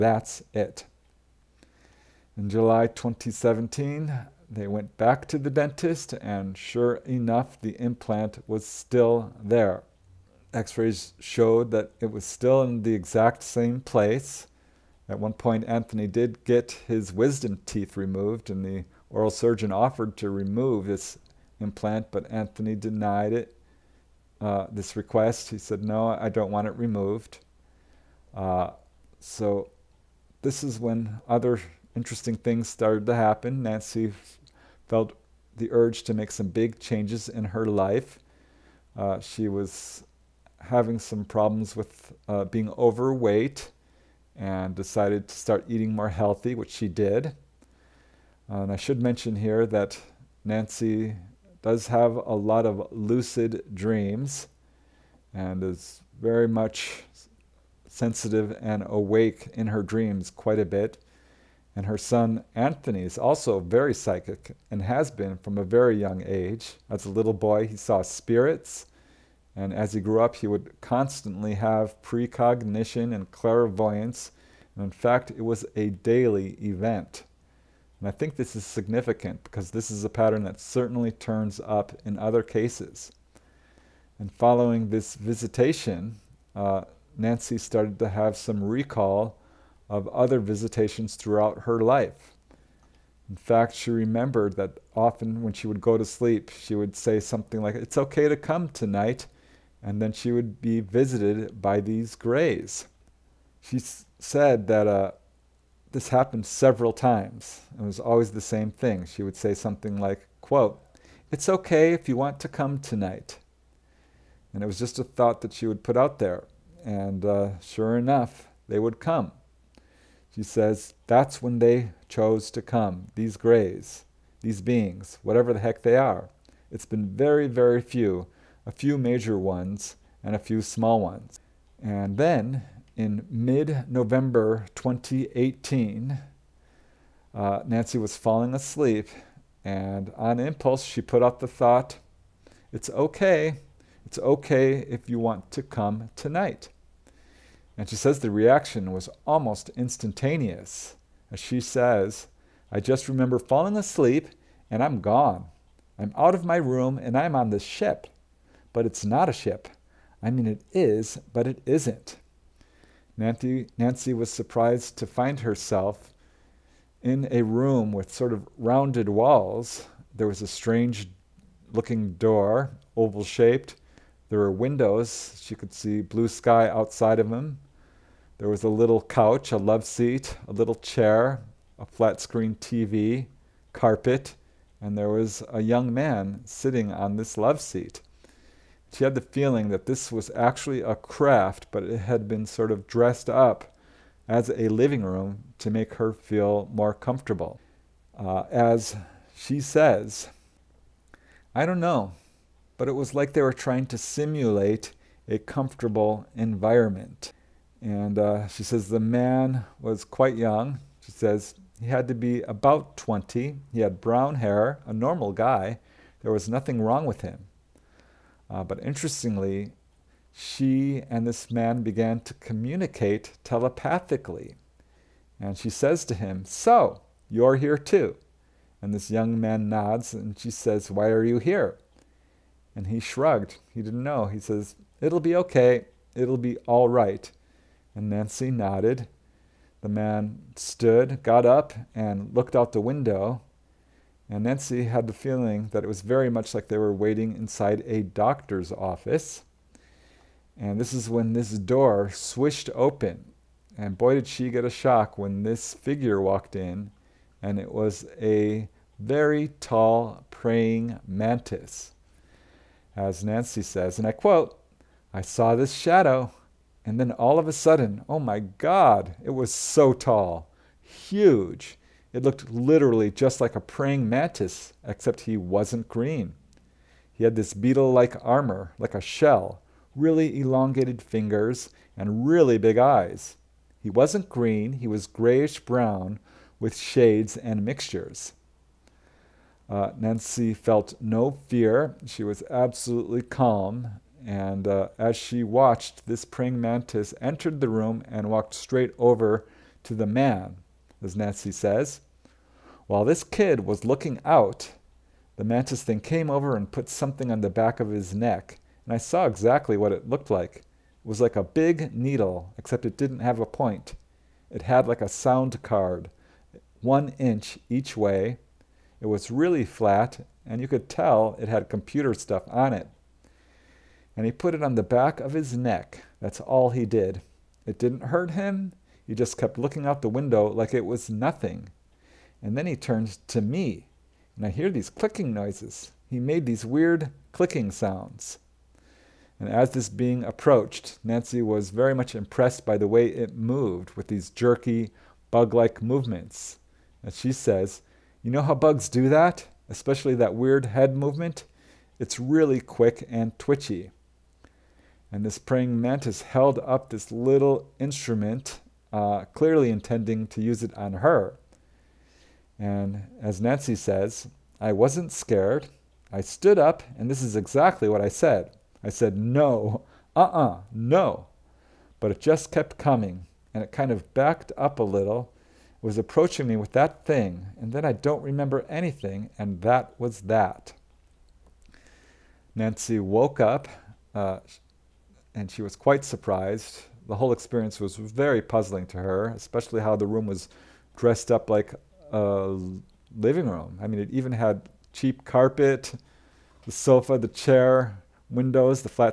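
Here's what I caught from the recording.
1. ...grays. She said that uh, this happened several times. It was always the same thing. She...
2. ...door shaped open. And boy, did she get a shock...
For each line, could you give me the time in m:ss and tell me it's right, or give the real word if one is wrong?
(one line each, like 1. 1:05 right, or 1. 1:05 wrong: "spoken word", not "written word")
1. 1:42 right
2. 4:11 wrong: "swished", not "shaped".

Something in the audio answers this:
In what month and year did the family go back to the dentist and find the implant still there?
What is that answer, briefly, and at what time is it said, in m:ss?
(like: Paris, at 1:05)
July 2017, at 0:02.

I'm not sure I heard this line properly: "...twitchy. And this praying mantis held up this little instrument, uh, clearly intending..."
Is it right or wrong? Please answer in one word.
right.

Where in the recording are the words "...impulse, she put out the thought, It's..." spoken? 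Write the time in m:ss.
2:20.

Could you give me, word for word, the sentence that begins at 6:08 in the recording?
I said, no, uh uh-uh, uh, no.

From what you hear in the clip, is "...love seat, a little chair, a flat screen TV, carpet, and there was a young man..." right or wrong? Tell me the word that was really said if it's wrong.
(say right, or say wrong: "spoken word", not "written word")
right.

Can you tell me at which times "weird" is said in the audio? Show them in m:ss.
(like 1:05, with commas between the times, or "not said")
5:36, 5:50.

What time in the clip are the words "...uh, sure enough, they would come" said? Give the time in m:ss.
1:57.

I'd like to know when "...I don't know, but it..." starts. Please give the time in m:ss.
3:21.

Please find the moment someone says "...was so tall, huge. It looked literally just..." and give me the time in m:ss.
4:29.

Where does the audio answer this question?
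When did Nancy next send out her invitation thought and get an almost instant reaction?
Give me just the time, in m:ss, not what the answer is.
2:13.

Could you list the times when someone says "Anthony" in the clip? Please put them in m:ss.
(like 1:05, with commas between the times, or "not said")
0:15, 0:22, 1:02.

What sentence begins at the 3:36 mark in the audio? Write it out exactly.
There was nothing wrong with him.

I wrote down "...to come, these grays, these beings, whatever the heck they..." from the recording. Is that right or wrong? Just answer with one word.
right.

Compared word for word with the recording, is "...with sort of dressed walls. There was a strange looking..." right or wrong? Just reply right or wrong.
wrong.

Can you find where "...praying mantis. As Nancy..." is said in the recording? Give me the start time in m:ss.
4:20.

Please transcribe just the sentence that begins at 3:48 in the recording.
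And this young man nods and she says, Why are you here?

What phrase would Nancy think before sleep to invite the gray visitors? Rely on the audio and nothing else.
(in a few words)
It's okay to come tonight.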